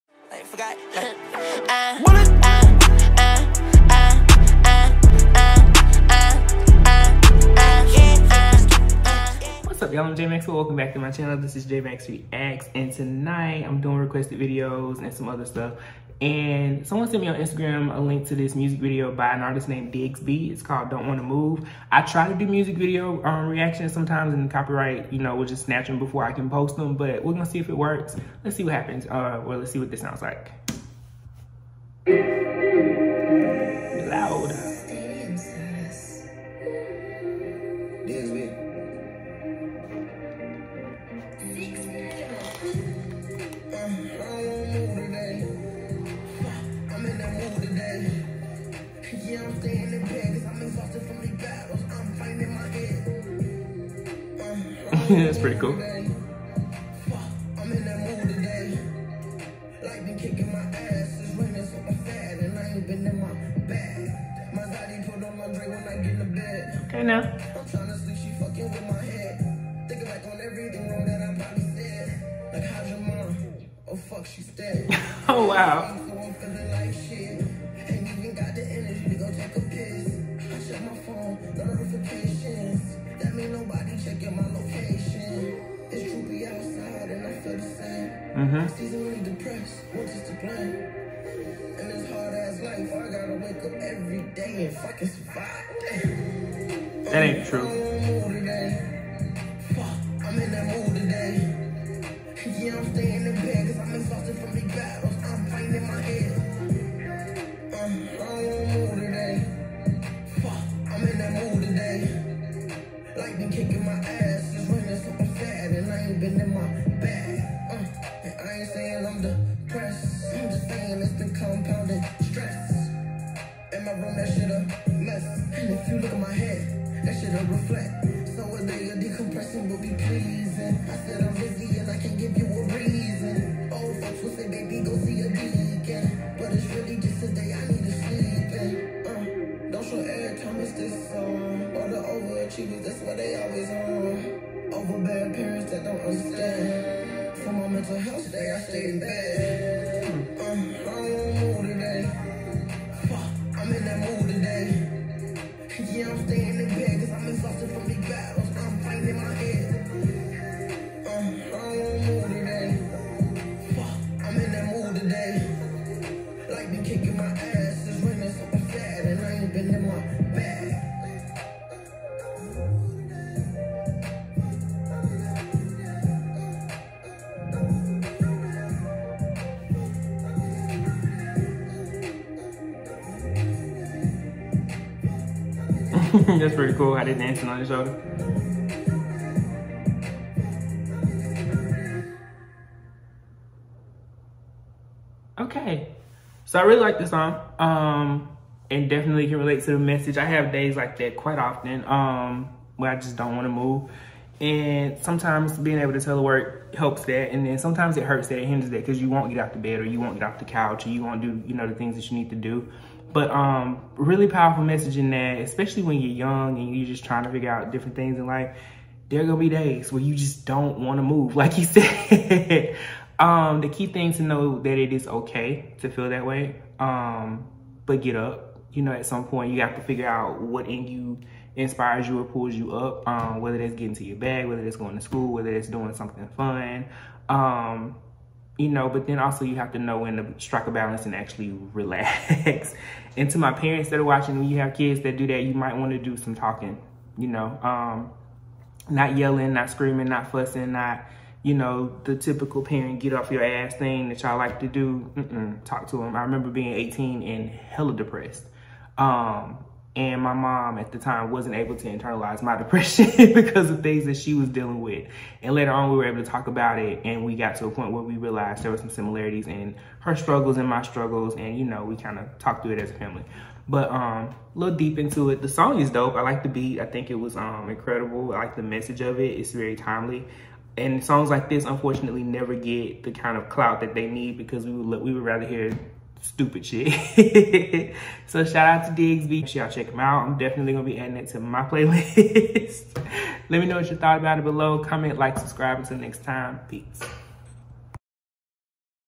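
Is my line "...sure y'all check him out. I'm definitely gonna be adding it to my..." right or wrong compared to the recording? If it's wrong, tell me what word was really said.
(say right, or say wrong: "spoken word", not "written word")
right.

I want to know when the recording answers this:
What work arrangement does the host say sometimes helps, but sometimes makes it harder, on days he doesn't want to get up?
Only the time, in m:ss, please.
3:25.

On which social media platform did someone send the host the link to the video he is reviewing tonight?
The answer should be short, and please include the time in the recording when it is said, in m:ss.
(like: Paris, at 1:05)
Instagram, at 0:17.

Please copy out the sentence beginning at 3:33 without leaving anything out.
But um, really powerful message in that, especially when you're young and you're just trying to figure out different things in life.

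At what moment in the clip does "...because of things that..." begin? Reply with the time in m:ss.
4:23.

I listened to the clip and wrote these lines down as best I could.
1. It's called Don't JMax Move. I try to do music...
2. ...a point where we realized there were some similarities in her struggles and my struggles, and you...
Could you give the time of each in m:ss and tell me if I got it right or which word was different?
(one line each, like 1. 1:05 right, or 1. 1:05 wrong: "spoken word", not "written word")
1. 0:20 wrong: "Wanna", not "JMax"
2. 4:27 right.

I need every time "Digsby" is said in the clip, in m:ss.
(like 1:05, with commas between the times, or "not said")
0:19, 4:49.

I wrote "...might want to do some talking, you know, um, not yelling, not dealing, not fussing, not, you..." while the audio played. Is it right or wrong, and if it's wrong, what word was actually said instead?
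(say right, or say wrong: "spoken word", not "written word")
wrong: "screaming", not "dealing".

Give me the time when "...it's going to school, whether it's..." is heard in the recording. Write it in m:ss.
3:54.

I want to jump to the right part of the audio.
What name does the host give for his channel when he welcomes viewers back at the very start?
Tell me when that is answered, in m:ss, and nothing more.
0:11.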